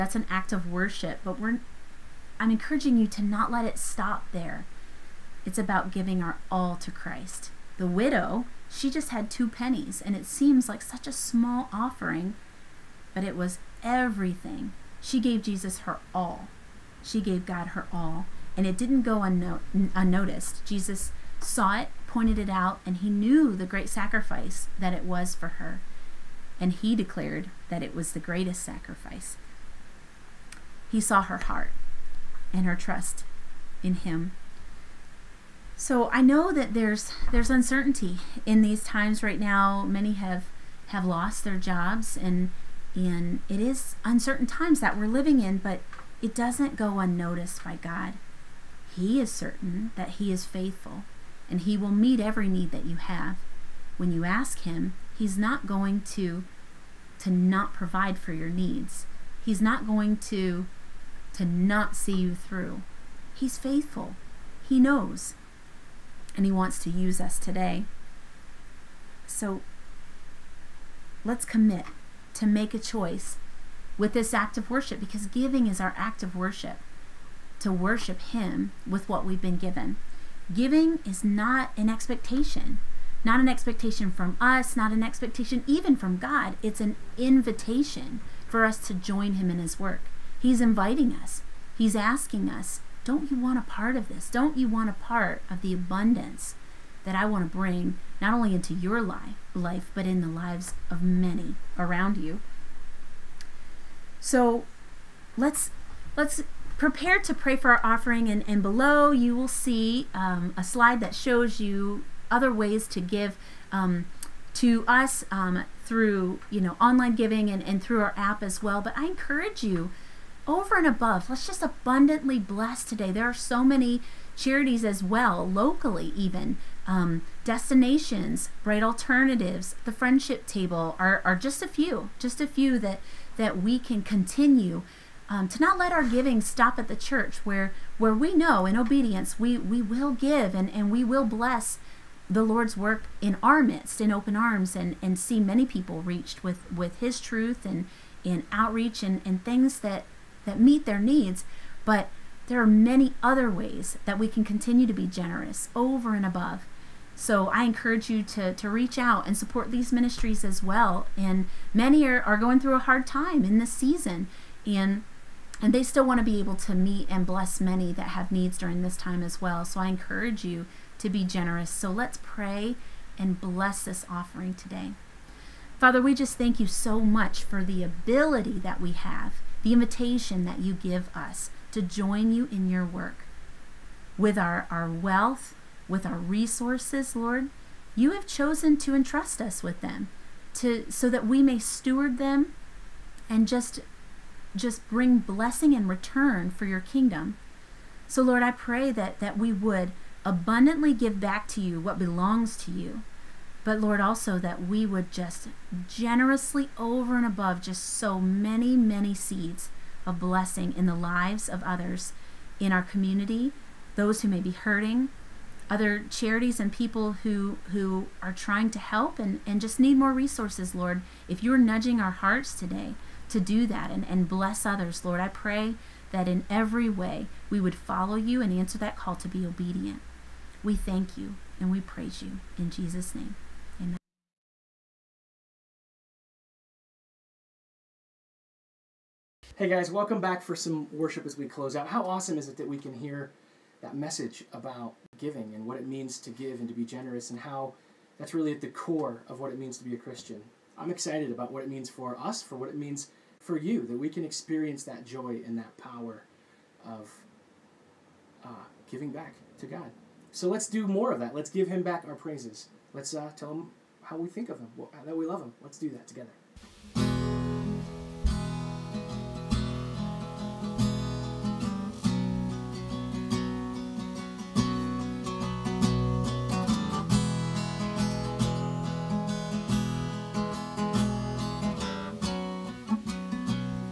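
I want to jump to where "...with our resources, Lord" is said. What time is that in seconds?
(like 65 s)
185 s.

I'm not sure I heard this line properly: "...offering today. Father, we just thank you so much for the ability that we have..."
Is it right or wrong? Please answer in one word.
right.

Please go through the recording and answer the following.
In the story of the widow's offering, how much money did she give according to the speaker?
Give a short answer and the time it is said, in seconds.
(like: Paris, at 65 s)
Two pennies, at 9 s.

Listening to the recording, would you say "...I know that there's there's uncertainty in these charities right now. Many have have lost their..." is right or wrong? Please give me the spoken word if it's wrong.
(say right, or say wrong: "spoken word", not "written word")
wrong: "times", not "charities".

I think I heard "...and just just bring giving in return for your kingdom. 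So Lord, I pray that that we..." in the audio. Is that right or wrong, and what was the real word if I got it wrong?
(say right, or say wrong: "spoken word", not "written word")
wrong: "blessing", not "giving".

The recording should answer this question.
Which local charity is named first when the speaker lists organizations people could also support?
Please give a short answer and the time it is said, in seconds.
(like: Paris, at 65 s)
Destinations, at 127 s.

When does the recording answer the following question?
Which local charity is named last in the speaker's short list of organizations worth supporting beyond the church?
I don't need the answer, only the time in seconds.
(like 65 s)
129 s.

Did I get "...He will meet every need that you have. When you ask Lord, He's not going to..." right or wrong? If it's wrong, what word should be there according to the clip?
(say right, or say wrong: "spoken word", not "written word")
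wrong: "Him", not "Lord".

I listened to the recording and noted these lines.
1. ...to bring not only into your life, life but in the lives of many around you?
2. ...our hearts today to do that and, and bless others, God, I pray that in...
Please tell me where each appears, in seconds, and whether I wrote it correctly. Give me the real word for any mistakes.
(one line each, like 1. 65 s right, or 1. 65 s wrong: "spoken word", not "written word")
1. 97 s right
2. 221 s wrong: "Lord", not "God".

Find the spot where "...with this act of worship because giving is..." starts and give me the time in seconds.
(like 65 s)
73 s.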